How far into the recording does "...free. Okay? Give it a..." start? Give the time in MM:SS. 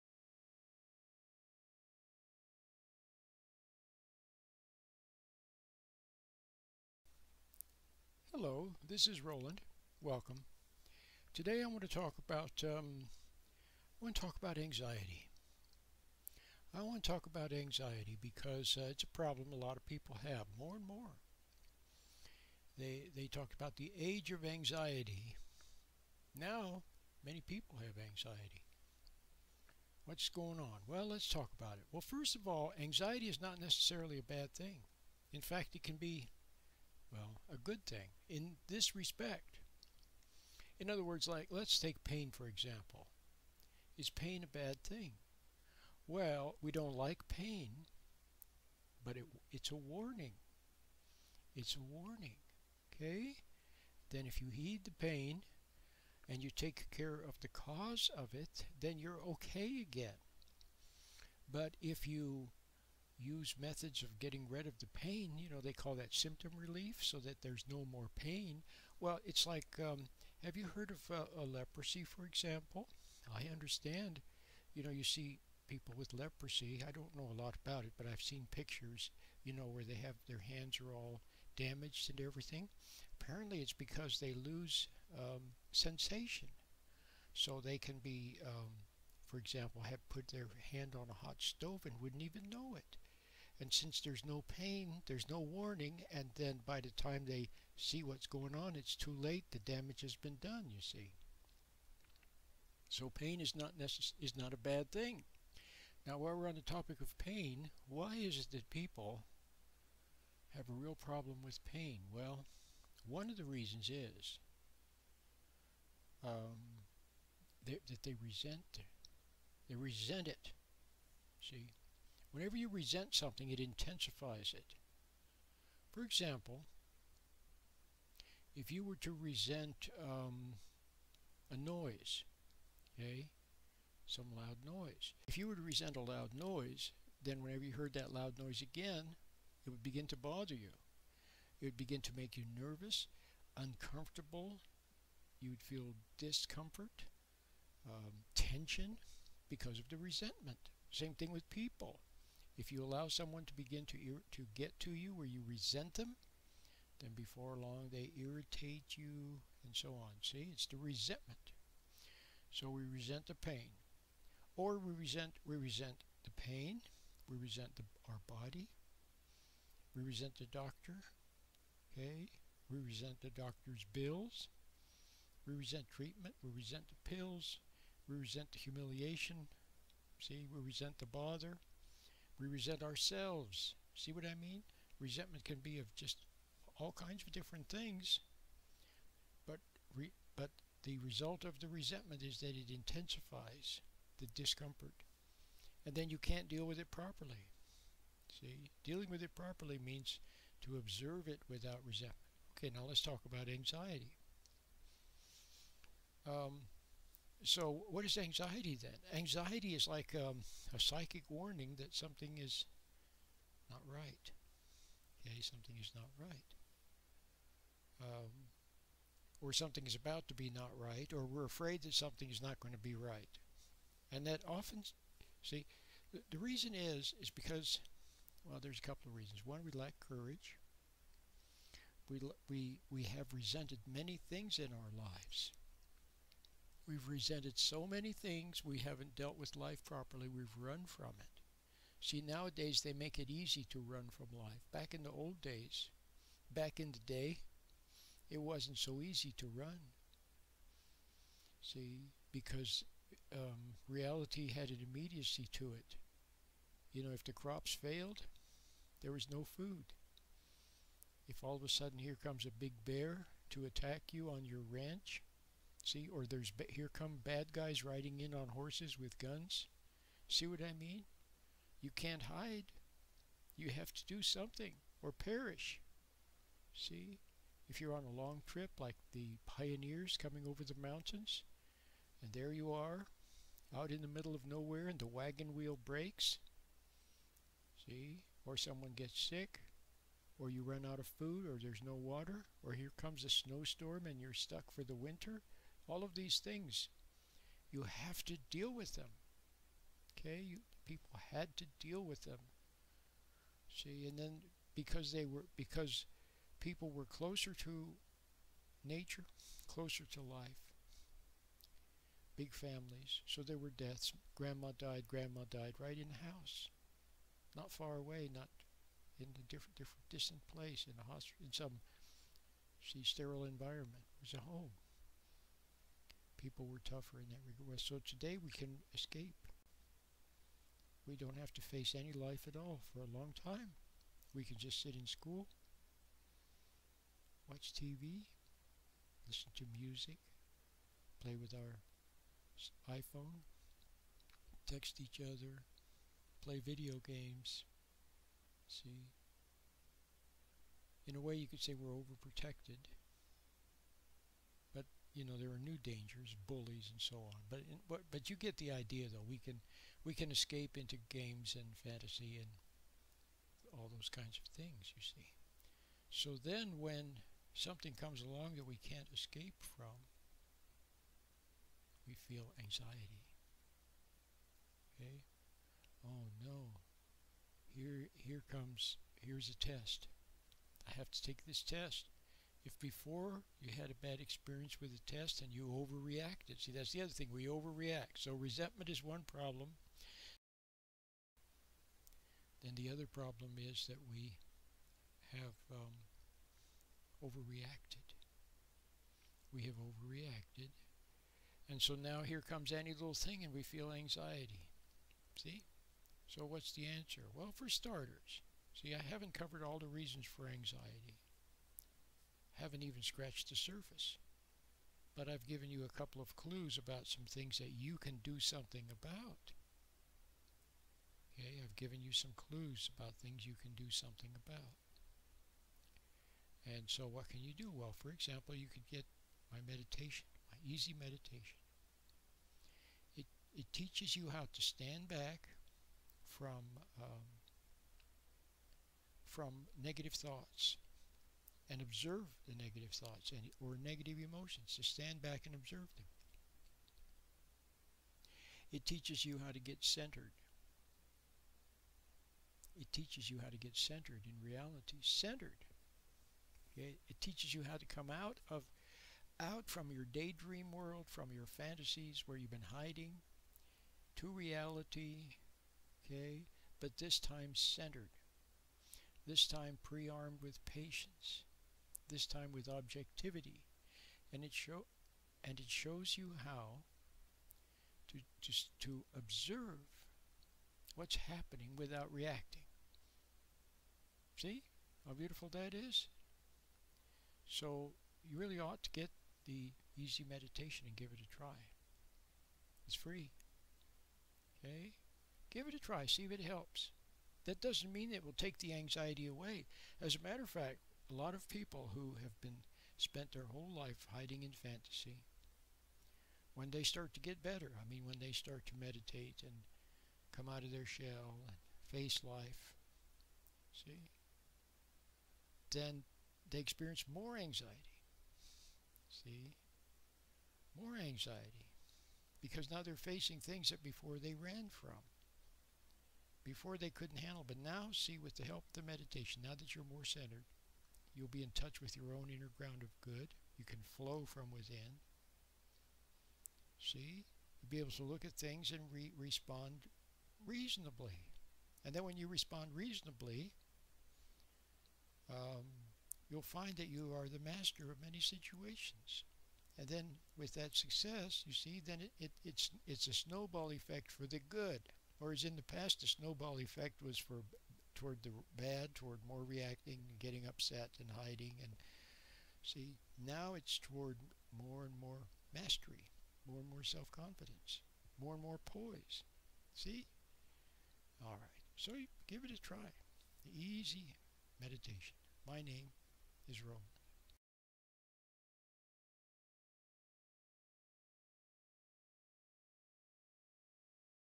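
08:12.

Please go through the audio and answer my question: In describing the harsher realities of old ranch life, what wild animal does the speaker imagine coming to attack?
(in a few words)
a big bear.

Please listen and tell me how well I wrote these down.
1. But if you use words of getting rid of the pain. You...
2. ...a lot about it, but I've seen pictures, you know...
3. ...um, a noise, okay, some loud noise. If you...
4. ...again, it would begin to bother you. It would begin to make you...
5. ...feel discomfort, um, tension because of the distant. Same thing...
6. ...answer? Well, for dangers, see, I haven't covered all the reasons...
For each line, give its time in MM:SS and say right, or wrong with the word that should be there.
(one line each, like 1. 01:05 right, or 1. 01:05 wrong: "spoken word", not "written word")
1. 01:01 wrong: "methods", not "words"
2. 01:17 right
3. 02:10 right
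4. 02:18 right
5. 02:25 wrong: "resentment", not "distant"
6. 06:46 wrong: "starters", not "dangers".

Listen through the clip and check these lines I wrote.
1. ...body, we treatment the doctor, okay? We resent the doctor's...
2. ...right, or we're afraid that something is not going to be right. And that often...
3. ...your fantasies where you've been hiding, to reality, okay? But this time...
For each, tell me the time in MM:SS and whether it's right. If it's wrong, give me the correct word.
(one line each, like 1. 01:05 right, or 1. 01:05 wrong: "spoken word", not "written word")
1. 02:48 wrong: "resent", not "treatment"
2. 03:40 right
3. 07:41 right.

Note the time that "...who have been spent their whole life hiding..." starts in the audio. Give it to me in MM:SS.
08:21.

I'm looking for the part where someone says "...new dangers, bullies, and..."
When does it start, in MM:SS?
05:55.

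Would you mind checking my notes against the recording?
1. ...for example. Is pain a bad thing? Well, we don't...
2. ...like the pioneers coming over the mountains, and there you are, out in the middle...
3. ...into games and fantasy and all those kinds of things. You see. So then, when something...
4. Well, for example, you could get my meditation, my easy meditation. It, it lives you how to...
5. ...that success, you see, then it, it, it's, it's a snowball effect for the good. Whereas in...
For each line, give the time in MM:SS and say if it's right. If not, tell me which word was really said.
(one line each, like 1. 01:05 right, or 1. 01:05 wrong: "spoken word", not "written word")
1. 00:42 right
2. 04:38 right
3. 06:00 right
4. 07:07 wrong: "teaches", not "lives"
5. 09:10 right.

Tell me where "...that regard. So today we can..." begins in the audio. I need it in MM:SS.
05:27.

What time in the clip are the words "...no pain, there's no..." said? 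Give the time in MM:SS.
01:34.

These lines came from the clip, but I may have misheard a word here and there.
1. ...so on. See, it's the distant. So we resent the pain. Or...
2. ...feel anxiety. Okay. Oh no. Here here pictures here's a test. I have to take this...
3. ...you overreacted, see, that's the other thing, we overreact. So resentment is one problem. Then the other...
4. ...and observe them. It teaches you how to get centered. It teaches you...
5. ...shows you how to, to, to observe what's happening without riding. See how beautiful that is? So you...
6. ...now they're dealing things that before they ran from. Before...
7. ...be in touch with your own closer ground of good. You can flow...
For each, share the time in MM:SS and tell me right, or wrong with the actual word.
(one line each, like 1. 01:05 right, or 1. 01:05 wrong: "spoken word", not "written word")
1. 02:39 wrong: "resentment", not "distant"
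2. 06:12 wrong: "comes", not "pictures"
3. 06:25 right
4. 07:25 right
5. 07:55 wrong: "reacting", not "riding"
6. 08:42 wrong: "facing", not "dealing"
7. 08:51 wrong: "inner", not "closer".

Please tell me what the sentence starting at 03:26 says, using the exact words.
Um, so what is anxiety then?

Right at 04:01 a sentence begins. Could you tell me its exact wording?
See, nowadays they make it easy to run from life.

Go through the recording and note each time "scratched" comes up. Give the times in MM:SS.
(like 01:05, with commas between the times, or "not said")
06:53.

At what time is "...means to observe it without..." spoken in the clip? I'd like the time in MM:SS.
03:19.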